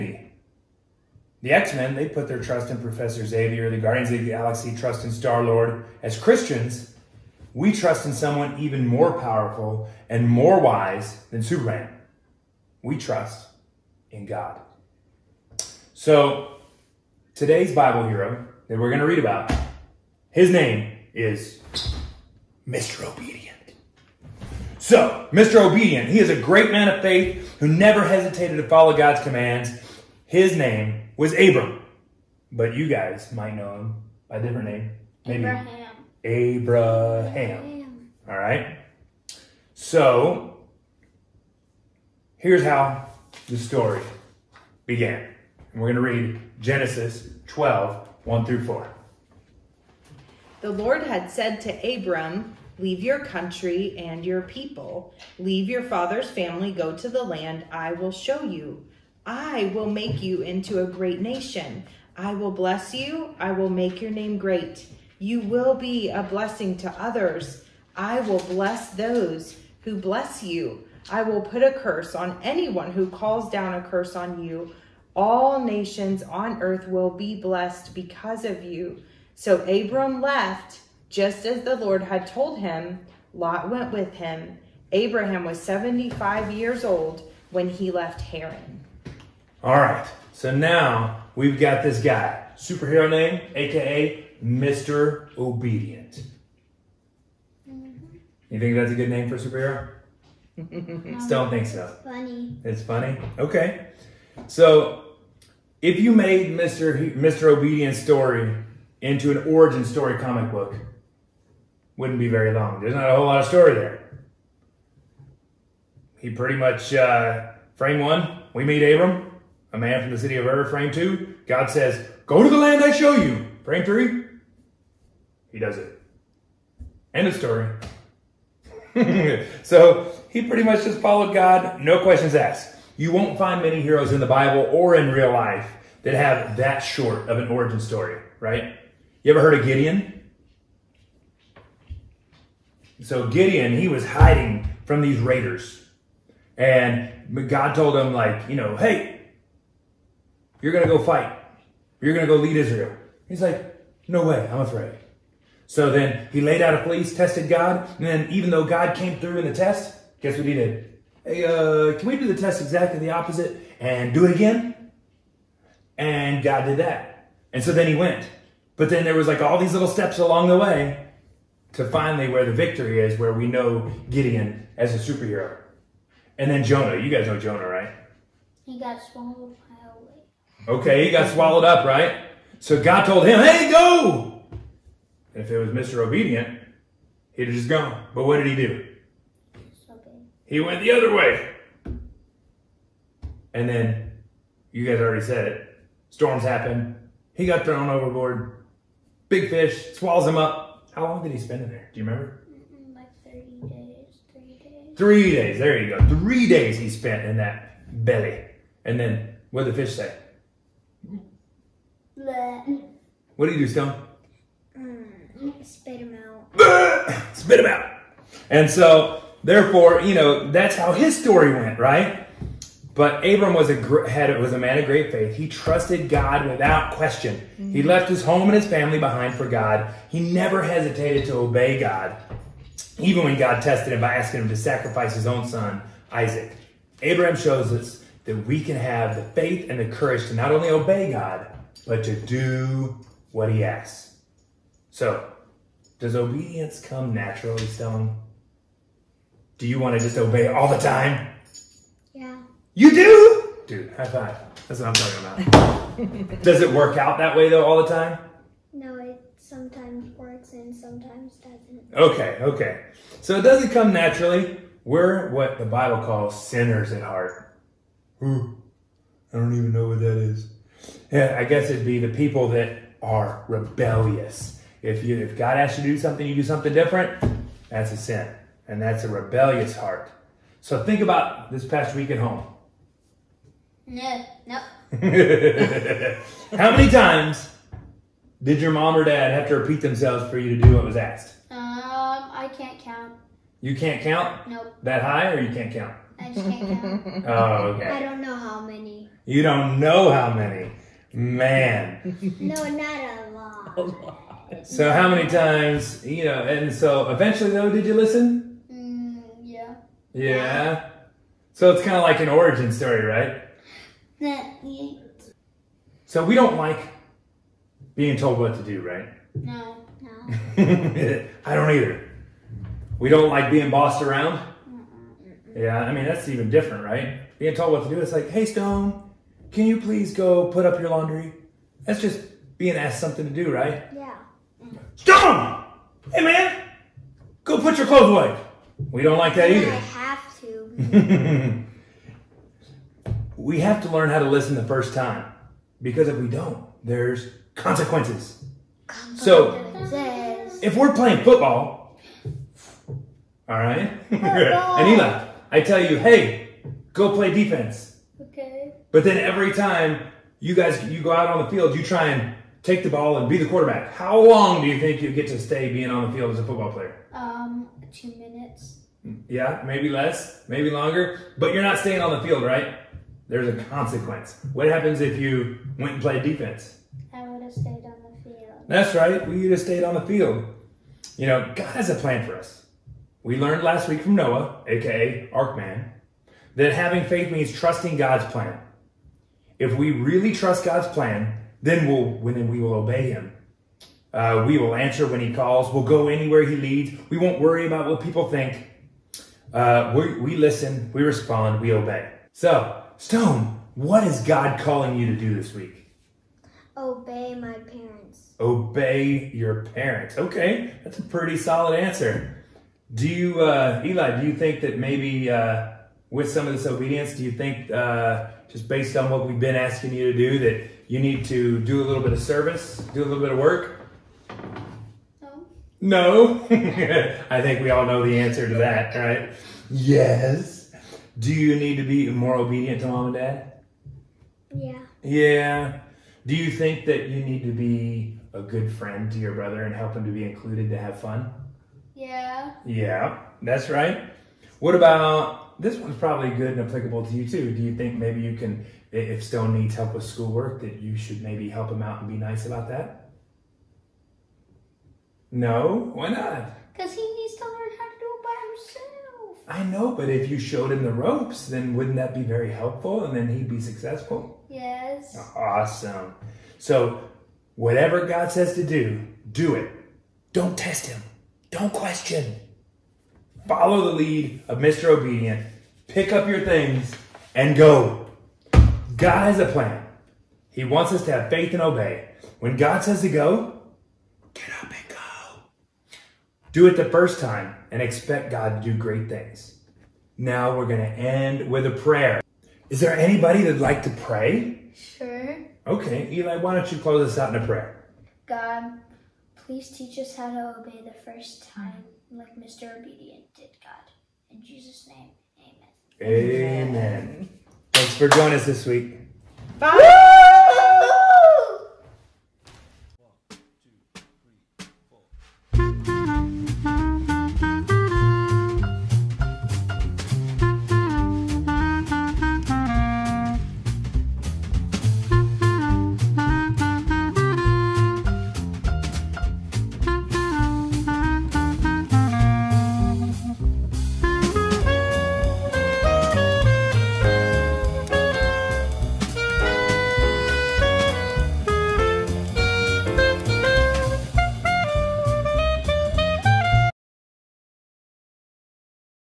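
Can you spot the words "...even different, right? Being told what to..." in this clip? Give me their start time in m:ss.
5:26.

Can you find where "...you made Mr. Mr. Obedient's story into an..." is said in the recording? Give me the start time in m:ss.
1:45.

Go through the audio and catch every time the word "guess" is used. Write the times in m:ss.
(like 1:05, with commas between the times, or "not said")
2:40, 4:31.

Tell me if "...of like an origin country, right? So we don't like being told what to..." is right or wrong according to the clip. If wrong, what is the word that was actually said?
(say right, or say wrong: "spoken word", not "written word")
wrong: "story", not "country".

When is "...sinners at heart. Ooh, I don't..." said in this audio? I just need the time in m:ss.
4:26.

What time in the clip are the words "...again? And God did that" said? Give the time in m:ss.
2:44.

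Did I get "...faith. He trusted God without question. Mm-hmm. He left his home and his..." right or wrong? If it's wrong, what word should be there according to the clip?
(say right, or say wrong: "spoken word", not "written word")
right.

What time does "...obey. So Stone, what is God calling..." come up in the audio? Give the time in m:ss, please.
6:41.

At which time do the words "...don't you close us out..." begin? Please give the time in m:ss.
8:16.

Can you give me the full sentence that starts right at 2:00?
Frame two, God says, Go to the land I show you.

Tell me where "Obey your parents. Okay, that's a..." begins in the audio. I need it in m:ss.
6:48.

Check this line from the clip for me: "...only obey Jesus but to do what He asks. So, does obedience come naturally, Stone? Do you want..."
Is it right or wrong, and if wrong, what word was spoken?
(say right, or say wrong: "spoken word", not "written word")
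wrong: "God", not "Jesus".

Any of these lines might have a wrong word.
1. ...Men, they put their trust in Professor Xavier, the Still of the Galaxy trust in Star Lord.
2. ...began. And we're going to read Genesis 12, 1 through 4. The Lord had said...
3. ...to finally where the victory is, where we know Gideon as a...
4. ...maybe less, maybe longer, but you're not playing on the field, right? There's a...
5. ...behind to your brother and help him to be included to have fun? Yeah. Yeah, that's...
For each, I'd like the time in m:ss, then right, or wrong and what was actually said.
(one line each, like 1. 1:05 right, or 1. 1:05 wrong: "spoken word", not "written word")
1. 0:01 wrong: "Guardians", not "Still"
2. 0:44 right
3. 2:51 right
4. 6:09 wrong: "staying", not "playing"
5. 7:18 wrong: "friend", not "behind".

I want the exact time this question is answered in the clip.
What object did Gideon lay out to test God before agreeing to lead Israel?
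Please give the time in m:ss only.
2:36.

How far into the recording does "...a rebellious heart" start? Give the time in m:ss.
4:39.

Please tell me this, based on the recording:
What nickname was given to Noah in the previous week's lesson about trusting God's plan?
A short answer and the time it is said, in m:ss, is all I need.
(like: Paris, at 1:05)
Arkman, at 6:25.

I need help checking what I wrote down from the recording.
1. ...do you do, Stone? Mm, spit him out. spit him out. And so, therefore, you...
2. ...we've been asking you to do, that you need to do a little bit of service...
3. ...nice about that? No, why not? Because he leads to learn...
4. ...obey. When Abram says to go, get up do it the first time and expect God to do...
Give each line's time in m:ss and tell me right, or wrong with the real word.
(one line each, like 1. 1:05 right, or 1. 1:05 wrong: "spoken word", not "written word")
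1. 3:33 right
2. 6:59 right
3. 7:32 wrong: "needs", not "leads"
4. 8:01 wrong: "God", not "Abram".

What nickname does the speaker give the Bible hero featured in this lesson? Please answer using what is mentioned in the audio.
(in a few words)
Mr. Obedience.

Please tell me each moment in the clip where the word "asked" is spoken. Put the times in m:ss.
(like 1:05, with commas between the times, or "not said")
2:12, 4:50, 5:32.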